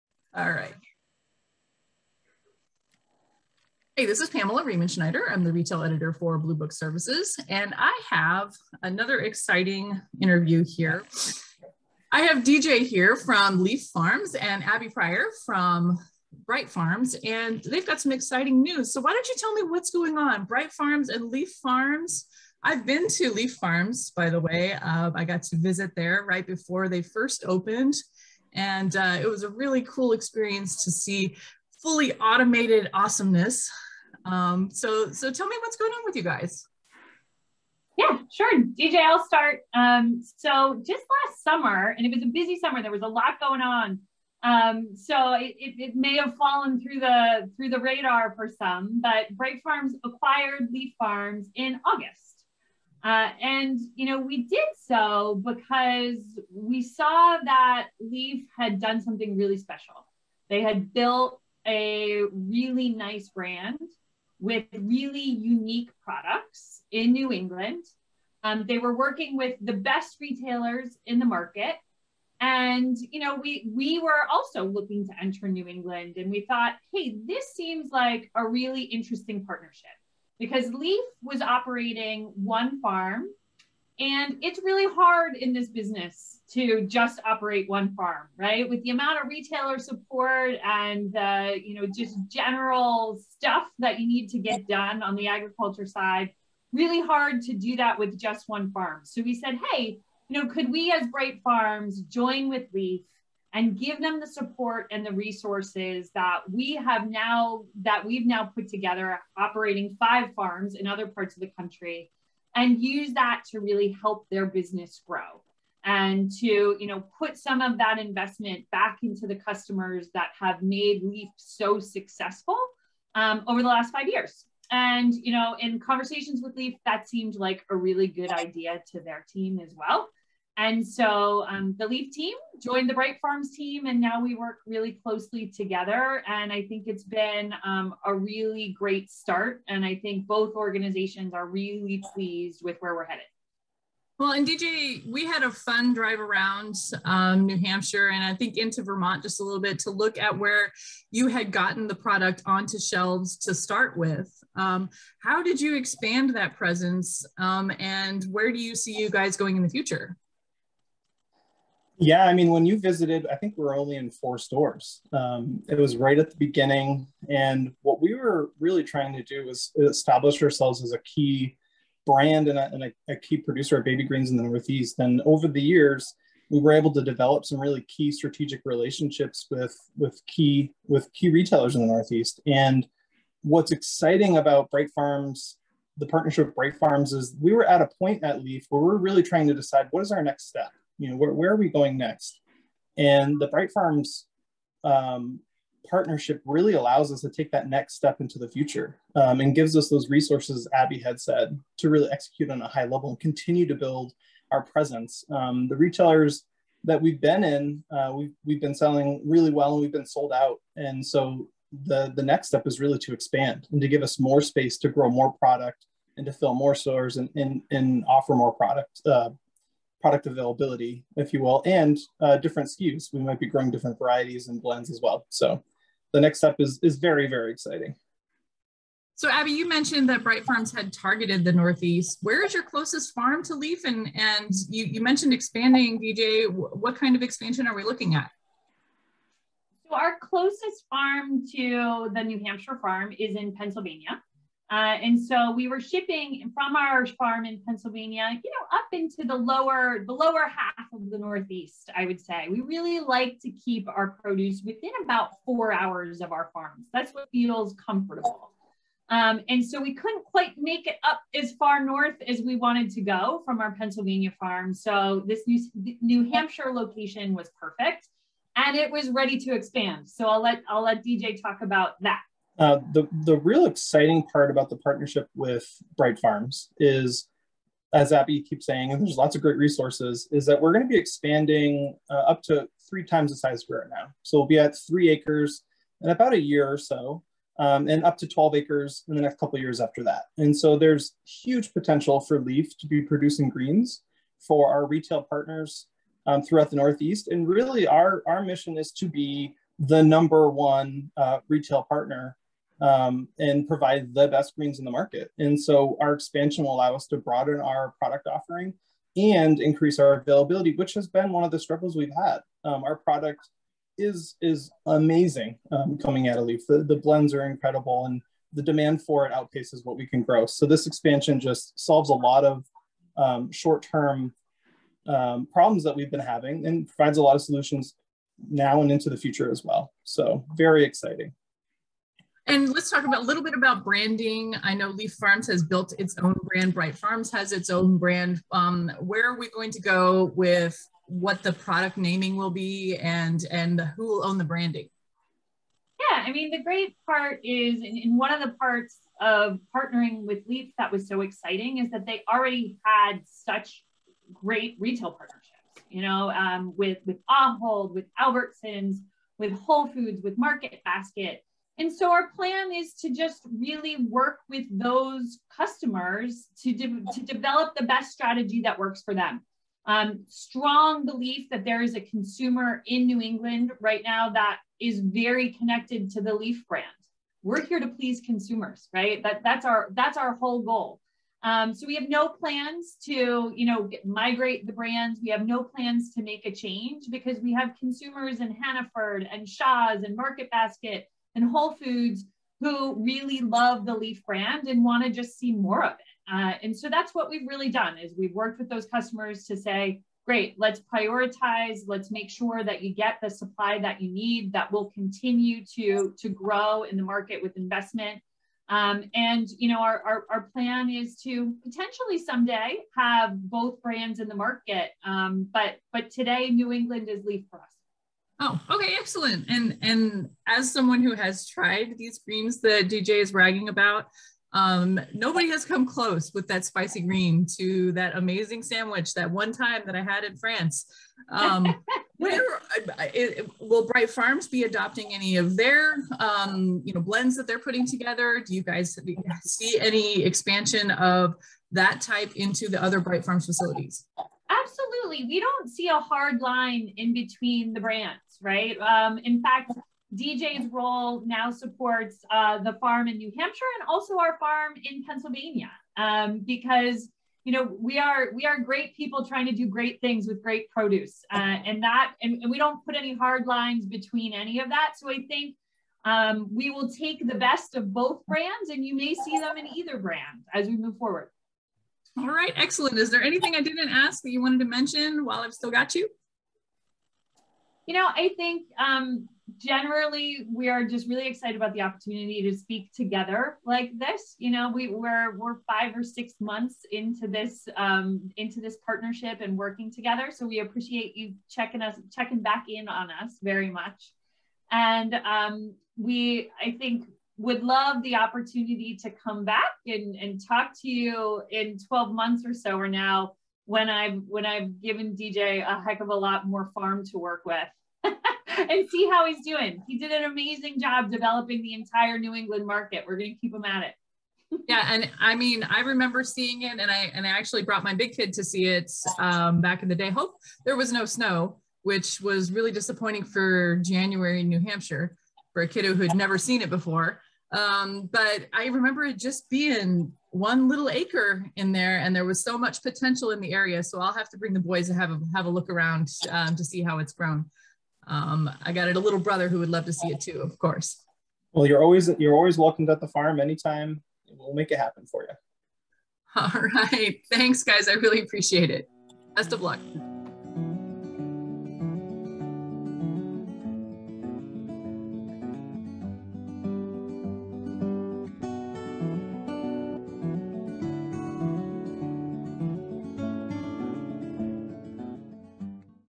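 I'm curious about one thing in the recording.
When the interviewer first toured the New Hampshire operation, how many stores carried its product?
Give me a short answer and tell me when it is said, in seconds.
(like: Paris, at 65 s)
4, at 164 s.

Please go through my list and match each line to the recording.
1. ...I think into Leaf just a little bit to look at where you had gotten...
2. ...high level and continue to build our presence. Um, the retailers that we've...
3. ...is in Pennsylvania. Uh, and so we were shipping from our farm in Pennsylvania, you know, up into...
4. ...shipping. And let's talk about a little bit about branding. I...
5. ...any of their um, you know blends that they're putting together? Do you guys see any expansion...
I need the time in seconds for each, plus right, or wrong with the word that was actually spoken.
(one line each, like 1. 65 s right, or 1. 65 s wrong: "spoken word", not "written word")
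1. 148 s wrong: "Vermont", not "Leaf"
2. 202 s right
3. 243 s right
4. 330 s wrong: "exciting", not "shipping"
5. 435 s right.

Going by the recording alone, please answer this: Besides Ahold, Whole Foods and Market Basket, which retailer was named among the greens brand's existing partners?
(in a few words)
Albertsons.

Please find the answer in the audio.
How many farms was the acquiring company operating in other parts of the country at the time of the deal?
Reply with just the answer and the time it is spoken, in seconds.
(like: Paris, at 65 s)
5, at 109 s.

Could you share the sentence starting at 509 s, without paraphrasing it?
He did an amazing job developing the entire New England market.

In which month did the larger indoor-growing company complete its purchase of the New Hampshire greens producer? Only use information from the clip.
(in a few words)
August.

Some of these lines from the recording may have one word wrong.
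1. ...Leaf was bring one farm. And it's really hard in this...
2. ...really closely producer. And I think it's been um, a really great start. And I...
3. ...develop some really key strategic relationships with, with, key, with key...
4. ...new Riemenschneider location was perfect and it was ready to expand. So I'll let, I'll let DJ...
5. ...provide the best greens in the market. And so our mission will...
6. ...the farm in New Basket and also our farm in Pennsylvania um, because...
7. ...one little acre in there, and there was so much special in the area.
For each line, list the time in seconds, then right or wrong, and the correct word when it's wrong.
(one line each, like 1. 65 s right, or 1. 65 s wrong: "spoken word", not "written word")
1. 80 s wrong: "operating", not "bring"
2. 134 s wrong: "together", not "producer"
3. 177 s right
4. 265 s wrong: "Hampshire", not "Riemenschneider"
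5. 303 s wrong: "expansion", not "mission"
6. 452 s wrong: "Hampshire", not "Basket"
7. 530 s wrong: "potential", not "special".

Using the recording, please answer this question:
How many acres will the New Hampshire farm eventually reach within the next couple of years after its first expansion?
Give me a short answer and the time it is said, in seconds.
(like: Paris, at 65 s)
12 acres, at 288 s.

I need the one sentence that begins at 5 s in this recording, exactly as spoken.
I'm the retail editor for Blue Book Services, and I have another exciting interview here.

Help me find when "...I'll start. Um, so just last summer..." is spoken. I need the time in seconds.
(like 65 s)
38 s.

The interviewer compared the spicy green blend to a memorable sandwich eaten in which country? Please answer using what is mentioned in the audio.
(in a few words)
France.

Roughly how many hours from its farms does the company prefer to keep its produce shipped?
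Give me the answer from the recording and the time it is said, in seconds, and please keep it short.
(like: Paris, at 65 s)
4 hours, at 255 s.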